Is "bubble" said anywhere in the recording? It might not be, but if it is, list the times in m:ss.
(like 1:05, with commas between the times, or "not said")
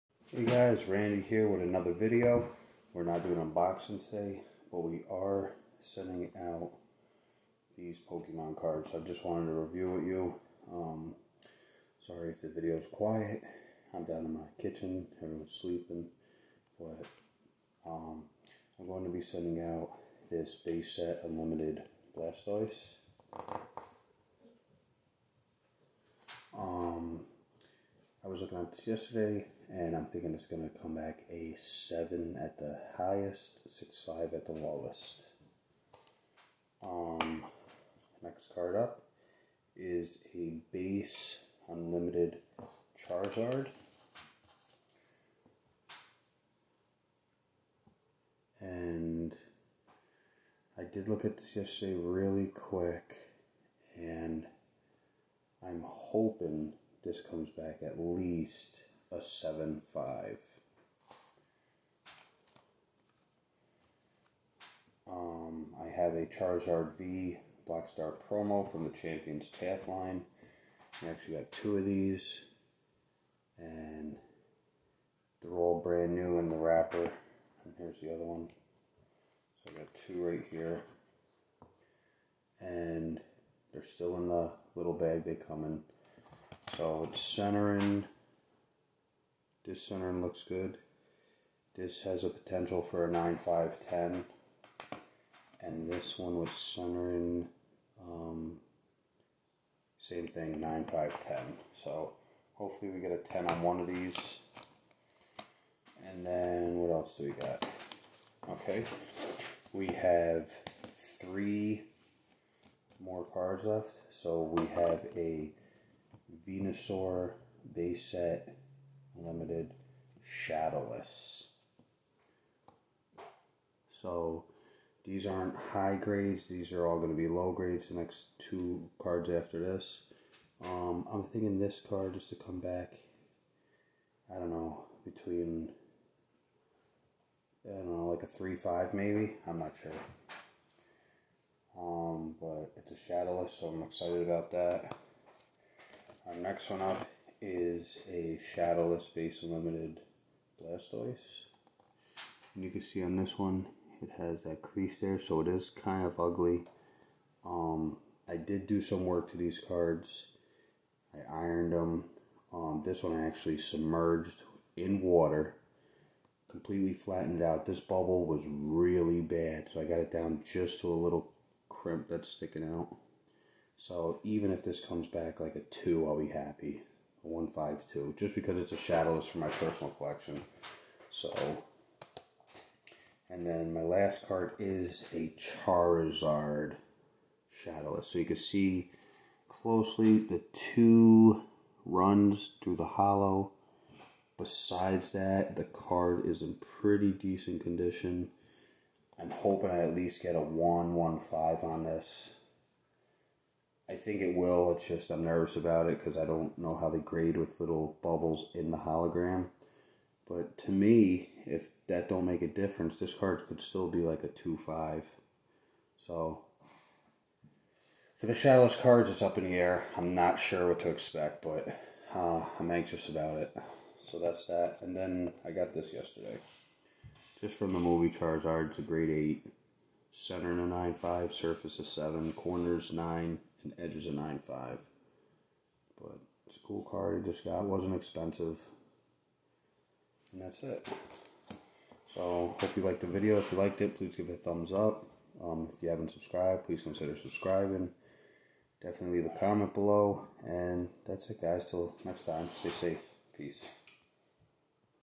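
2:47, 3:28.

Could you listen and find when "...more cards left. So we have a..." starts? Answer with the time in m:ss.
1:52.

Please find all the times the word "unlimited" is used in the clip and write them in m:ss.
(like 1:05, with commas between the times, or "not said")
0:21, 0:41, 2:29.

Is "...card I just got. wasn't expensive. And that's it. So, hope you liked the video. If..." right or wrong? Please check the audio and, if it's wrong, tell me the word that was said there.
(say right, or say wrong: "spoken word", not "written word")
right.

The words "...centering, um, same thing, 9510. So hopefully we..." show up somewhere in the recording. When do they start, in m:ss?
1:36.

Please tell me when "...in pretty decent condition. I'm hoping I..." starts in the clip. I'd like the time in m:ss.
3:16.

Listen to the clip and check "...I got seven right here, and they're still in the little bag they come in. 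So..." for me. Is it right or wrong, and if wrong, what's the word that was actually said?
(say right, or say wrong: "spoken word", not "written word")
wrong: "two", not "seven".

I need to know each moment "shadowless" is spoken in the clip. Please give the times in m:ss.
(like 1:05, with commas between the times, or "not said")
2:00, 2:23, 2:28, 2:58, 3:07, 3:38.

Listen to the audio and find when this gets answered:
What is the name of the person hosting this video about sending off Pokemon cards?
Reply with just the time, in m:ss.
0:00.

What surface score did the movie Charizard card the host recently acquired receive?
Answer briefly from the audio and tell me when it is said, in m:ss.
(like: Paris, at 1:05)
7, at 3:51.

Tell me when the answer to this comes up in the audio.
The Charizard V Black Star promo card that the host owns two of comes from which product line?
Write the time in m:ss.
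1:08.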